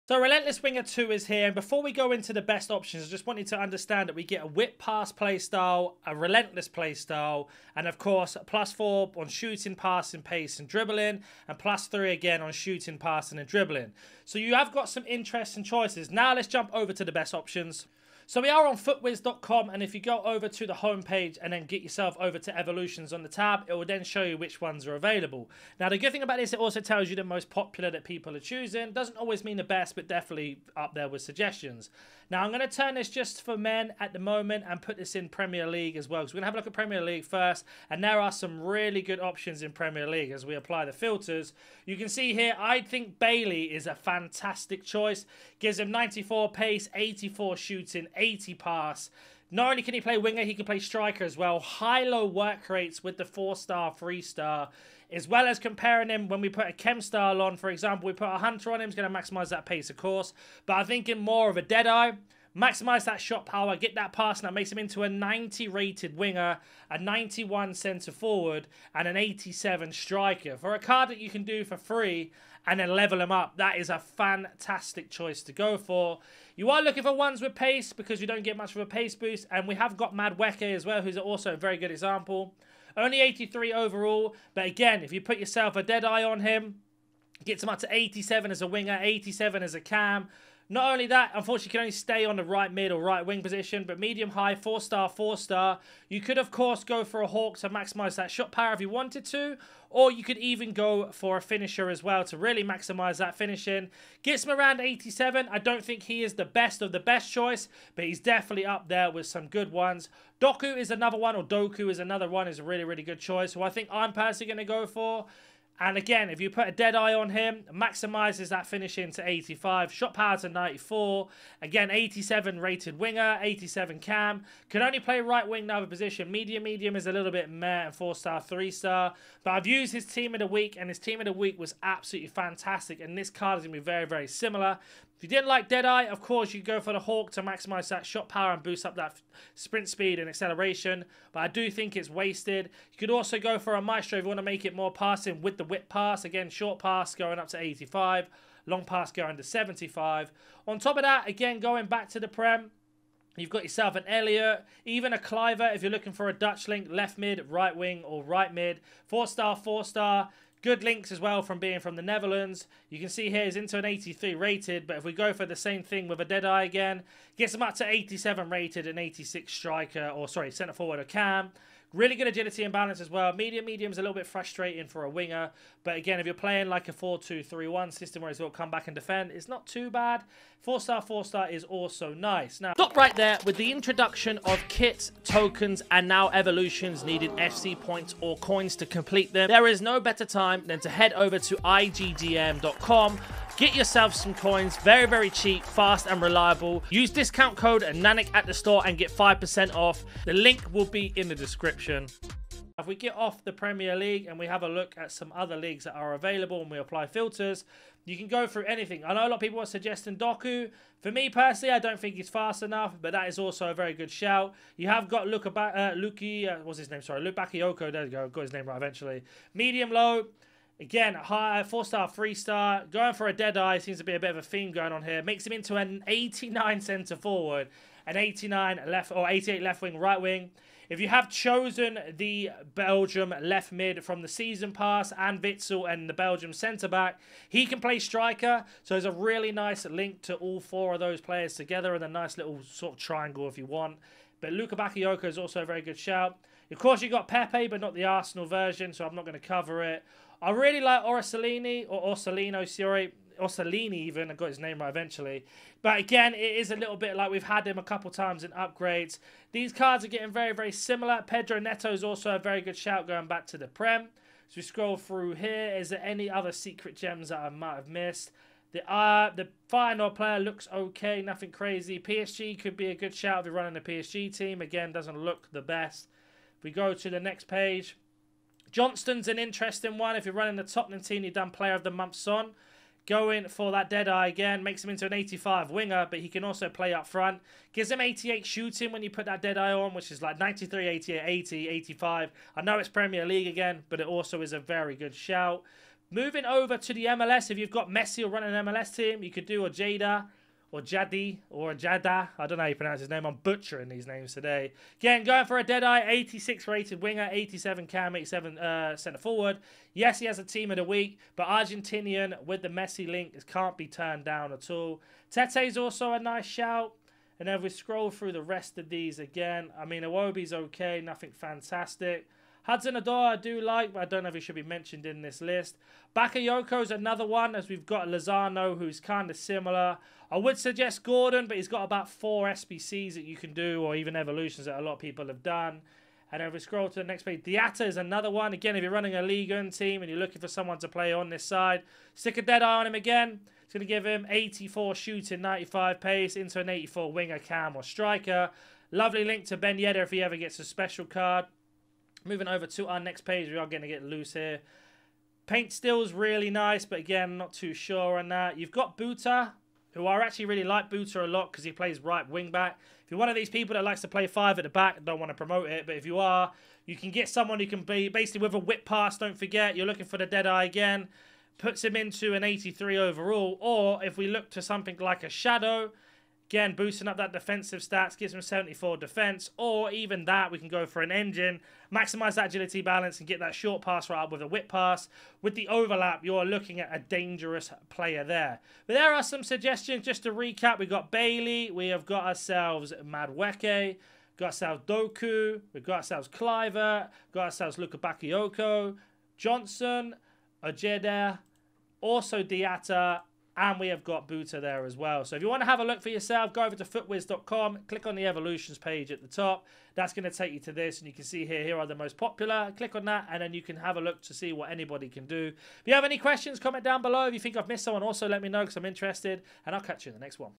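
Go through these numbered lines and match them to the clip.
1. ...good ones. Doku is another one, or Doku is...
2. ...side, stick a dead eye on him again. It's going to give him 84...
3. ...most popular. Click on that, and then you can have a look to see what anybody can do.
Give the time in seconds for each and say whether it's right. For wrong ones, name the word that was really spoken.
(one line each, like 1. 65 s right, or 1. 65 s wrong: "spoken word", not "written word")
1. 109 s right
2. 341 s right
3. 411 s right.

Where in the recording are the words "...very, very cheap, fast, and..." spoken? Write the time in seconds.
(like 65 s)
194 s.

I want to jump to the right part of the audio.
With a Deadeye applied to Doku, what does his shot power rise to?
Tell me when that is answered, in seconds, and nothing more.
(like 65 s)
119 s.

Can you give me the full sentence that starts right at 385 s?
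With the overlap, you're looking at a dangerous player there.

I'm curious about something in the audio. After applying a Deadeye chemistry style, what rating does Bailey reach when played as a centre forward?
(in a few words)
91.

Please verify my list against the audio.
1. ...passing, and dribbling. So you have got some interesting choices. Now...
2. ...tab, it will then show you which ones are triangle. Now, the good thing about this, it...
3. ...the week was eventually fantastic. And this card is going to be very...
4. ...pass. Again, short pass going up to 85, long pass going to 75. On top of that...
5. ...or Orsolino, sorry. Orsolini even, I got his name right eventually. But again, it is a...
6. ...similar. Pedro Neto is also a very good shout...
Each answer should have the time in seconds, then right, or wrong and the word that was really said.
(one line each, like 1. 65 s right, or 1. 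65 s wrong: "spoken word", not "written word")
1. 12 s right
2. 23 s wrong: "available", not "triangle"
3. 131 s wrong: "absolutely", not "eventually"
4. 145 s right
5. 251 s right
6. 260 s right.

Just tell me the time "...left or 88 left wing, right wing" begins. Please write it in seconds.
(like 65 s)
228 s.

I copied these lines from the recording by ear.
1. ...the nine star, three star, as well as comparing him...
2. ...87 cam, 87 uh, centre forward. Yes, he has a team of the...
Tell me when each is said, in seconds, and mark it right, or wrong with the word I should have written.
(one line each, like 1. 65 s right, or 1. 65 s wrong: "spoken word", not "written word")
1. 53 s wrong: "four", not "nine"
2. 307 s right.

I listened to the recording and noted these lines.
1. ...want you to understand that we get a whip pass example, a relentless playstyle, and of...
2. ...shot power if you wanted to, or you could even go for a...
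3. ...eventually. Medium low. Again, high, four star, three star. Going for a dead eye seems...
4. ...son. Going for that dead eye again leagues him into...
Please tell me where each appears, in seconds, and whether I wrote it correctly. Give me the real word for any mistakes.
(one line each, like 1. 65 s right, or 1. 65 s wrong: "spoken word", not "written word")
1. 3 s wrong: "playstyle", not "example"
2. 98 s right
3. 218 s right
4. 282 s wrong: "makes", not "leagues".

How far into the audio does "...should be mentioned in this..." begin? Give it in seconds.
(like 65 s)
324 s.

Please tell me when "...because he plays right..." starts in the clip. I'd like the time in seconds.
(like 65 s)
361 s.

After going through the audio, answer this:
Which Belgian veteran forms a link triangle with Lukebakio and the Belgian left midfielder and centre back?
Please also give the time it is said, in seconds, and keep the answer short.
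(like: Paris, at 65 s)
Witsel, at 235 s.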